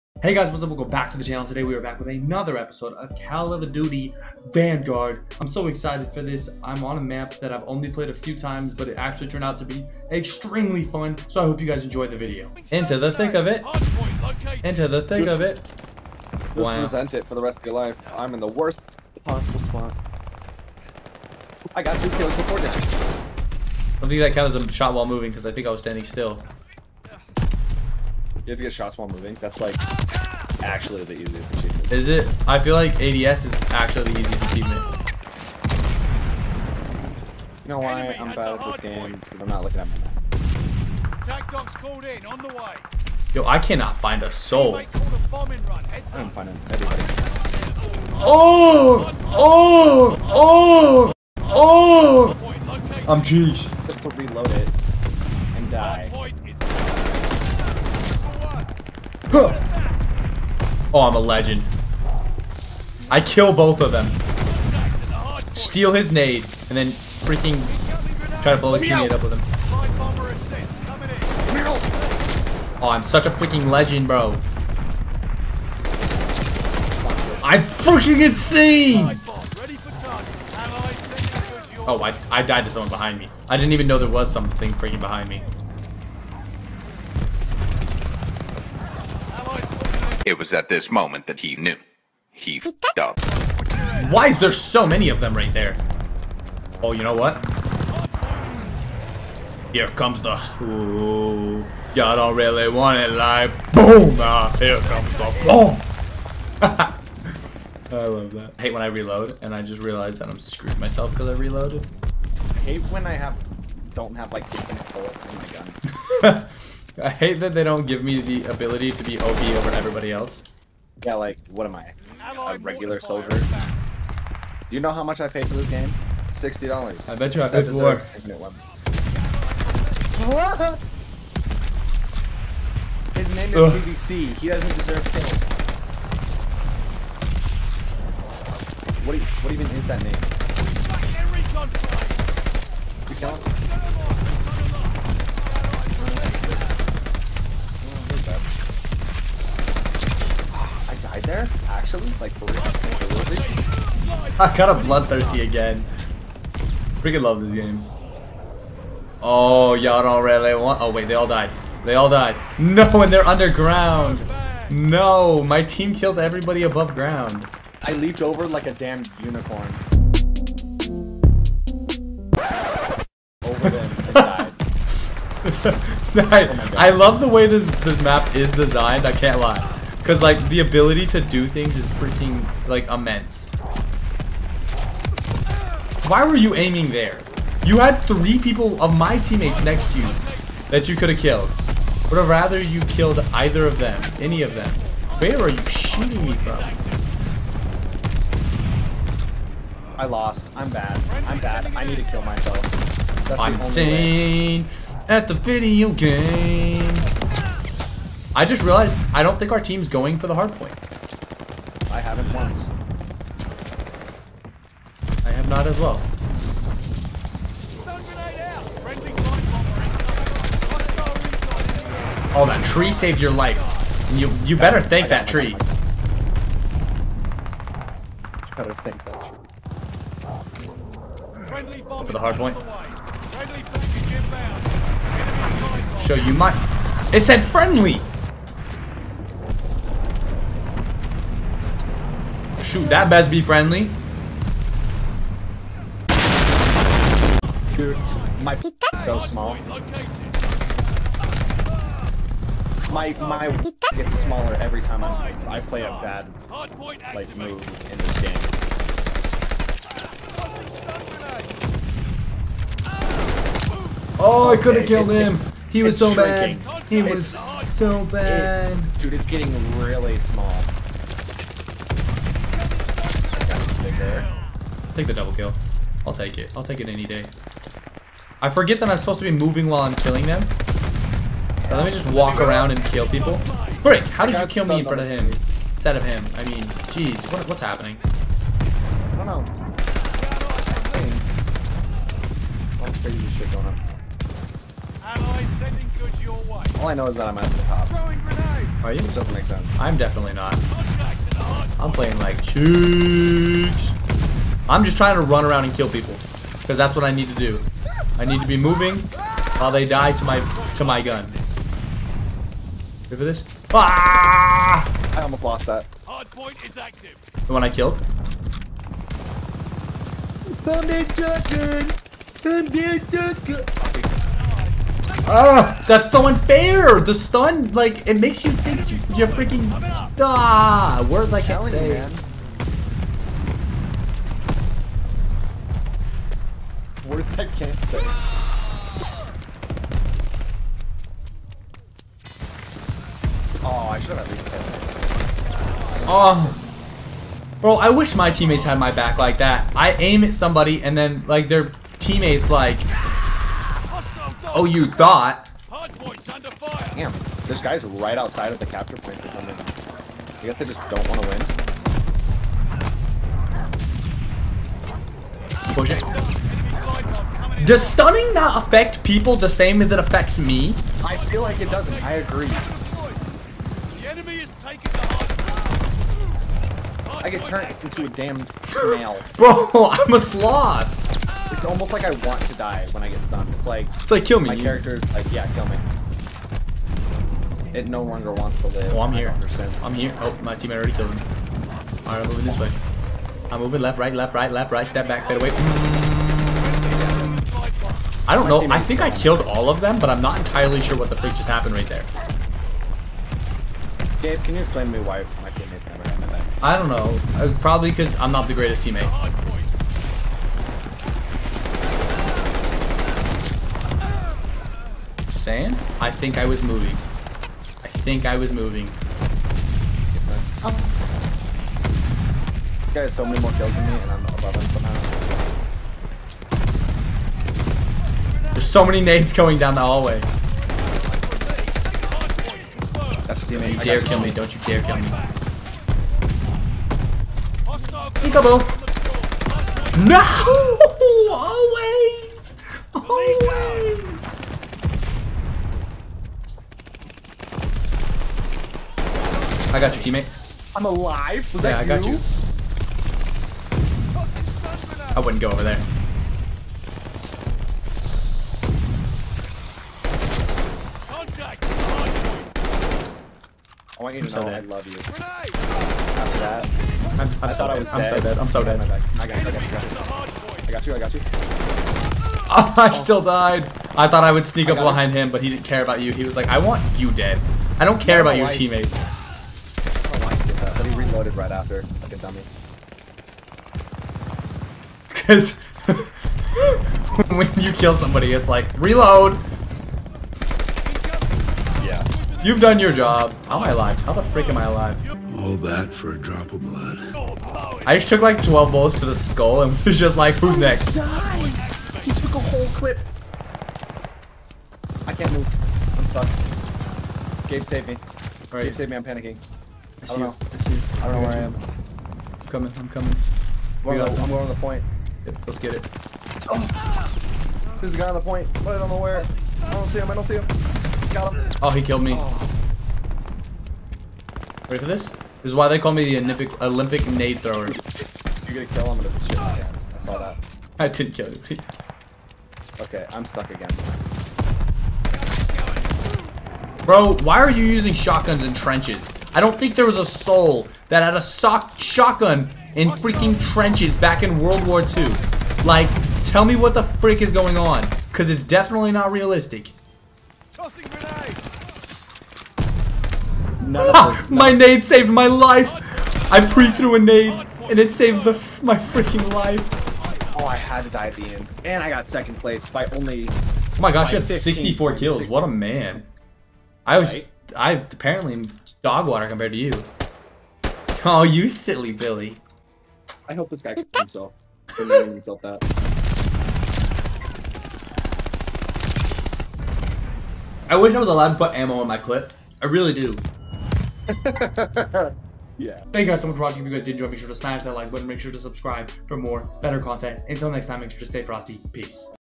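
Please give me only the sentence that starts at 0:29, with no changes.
That's like actually the easiest achievement.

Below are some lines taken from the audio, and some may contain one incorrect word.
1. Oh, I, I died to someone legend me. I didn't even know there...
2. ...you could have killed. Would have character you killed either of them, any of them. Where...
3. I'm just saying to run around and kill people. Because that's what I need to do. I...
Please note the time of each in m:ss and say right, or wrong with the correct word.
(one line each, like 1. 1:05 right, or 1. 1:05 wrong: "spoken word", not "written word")
1. 1:21 wrong: "behind", not "legend"
2. 3:10 wrong: "rather", not "character"
3. 5:04 wrong: "trying", not "saying".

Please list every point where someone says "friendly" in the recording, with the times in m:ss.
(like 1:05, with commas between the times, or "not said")
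3:57, 4:03.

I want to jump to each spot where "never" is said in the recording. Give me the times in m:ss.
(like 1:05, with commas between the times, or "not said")
6:45.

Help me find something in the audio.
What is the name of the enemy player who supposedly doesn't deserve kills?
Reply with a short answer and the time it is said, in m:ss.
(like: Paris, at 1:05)
CBC, at 2:13.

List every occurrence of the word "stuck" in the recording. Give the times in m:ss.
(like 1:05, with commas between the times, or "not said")
8:26, 8:53.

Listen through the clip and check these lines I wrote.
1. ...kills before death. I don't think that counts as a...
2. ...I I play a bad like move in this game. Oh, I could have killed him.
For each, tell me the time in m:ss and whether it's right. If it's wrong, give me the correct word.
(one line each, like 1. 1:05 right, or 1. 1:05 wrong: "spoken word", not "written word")
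1. 0:22 right
2. 4:15 right.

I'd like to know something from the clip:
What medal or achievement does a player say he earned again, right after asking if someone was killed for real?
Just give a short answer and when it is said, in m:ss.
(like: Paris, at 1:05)
Bloodthirsty, at 2:34.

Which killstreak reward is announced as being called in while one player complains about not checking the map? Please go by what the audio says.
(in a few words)
Attack dogs.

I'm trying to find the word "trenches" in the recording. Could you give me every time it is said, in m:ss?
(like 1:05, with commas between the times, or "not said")
8:58, 9:03.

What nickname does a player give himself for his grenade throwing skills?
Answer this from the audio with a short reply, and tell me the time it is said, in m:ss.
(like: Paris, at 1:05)
Olympic nade thrower, at 8:46.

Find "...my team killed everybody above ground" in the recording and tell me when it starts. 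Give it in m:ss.
2:45.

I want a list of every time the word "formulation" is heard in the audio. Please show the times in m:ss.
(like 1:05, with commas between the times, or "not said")
not said.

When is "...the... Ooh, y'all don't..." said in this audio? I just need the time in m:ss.
1:40.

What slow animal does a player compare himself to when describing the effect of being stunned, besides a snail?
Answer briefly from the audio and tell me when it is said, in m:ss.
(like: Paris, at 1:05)
Sloth, at 6:20.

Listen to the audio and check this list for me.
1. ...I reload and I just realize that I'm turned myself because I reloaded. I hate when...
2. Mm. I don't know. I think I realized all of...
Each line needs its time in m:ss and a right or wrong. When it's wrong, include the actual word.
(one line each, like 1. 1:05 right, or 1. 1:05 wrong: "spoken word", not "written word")
1. 1:48 wrong: "screwed", not "turned"
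2. 6:35 wrong: "killed", not "realized".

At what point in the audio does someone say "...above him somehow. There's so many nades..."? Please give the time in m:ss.
7:04.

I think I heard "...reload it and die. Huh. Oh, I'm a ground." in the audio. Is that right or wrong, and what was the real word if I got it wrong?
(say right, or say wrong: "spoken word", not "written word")
wrong: "legend", not "ground".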